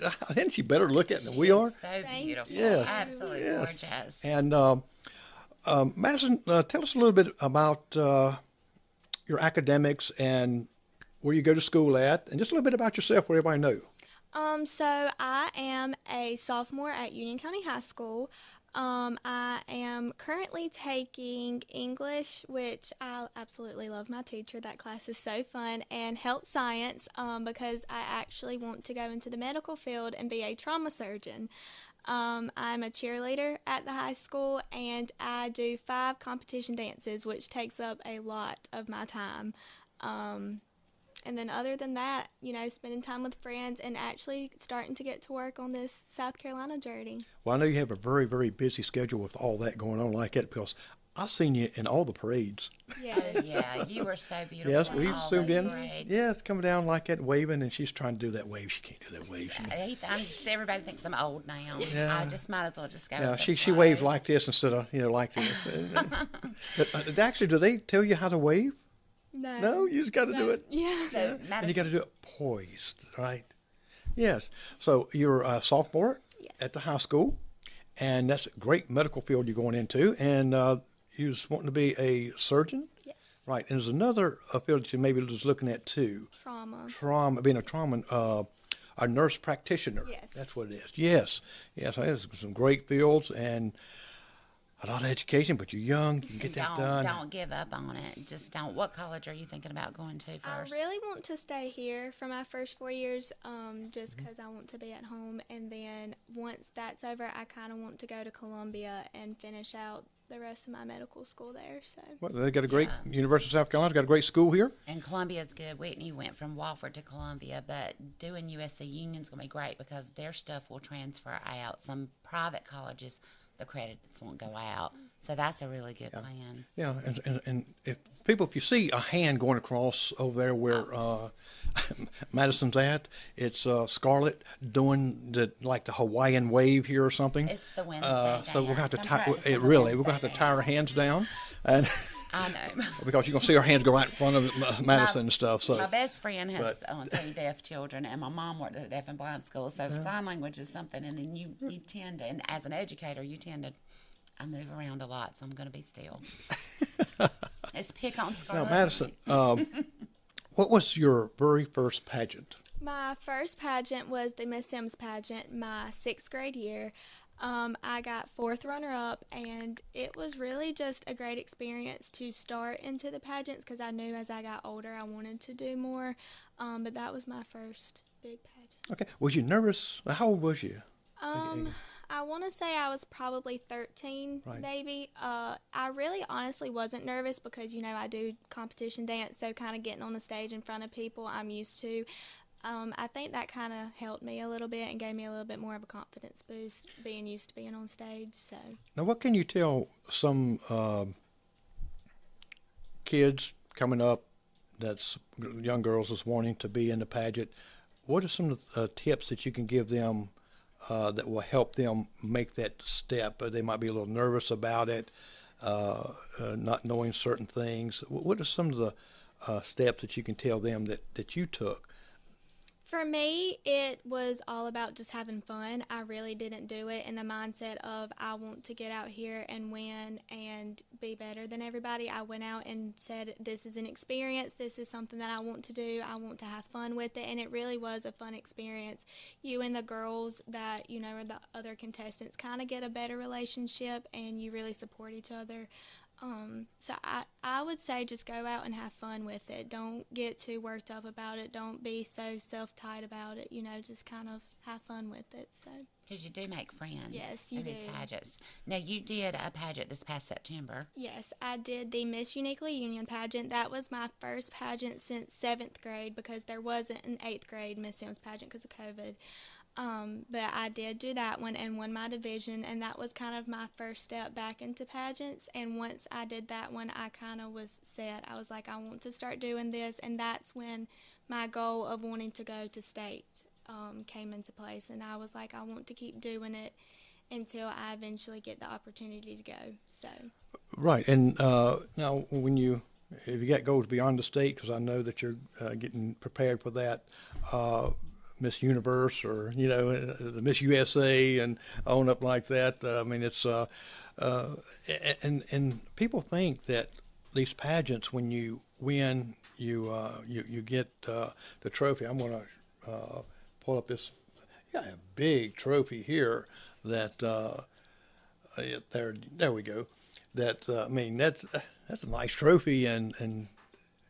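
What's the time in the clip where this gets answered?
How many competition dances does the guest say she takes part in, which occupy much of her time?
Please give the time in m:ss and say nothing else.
0:35.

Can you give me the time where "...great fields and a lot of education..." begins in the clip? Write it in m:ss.
1:32.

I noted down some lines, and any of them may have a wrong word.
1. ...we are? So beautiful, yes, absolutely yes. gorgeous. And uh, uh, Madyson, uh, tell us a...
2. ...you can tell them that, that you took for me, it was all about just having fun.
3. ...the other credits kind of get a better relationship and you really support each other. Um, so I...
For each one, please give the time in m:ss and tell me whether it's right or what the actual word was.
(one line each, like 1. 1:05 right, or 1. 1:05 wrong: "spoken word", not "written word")
1. 0:01 right
2. 3:40 right
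3. 4:01 wrong: "contestants", not "credits".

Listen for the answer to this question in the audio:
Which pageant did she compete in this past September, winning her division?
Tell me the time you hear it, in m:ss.
4:22.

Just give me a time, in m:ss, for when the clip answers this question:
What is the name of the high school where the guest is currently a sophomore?
0:17.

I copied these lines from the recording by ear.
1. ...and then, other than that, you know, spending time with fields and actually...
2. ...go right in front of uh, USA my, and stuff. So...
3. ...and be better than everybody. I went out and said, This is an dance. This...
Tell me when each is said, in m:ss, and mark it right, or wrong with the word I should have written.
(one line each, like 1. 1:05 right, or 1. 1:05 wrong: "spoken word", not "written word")
1. 0:41 wrong: "friends", not "fields"
2. 2:23 wrong: "Madyson", not "USA"
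3. 3:50 wrong: "experience", not "dance".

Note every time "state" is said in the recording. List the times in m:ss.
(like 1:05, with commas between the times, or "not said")
4:42, 4:54.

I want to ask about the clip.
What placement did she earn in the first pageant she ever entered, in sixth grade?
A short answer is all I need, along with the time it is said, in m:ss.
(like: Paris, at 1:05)
Fourth runner up, at 2:48.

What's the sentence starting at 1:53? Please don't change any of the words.
University of South Carolina's got a great school here.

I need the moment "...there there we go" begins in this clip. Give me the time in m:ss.
5:18.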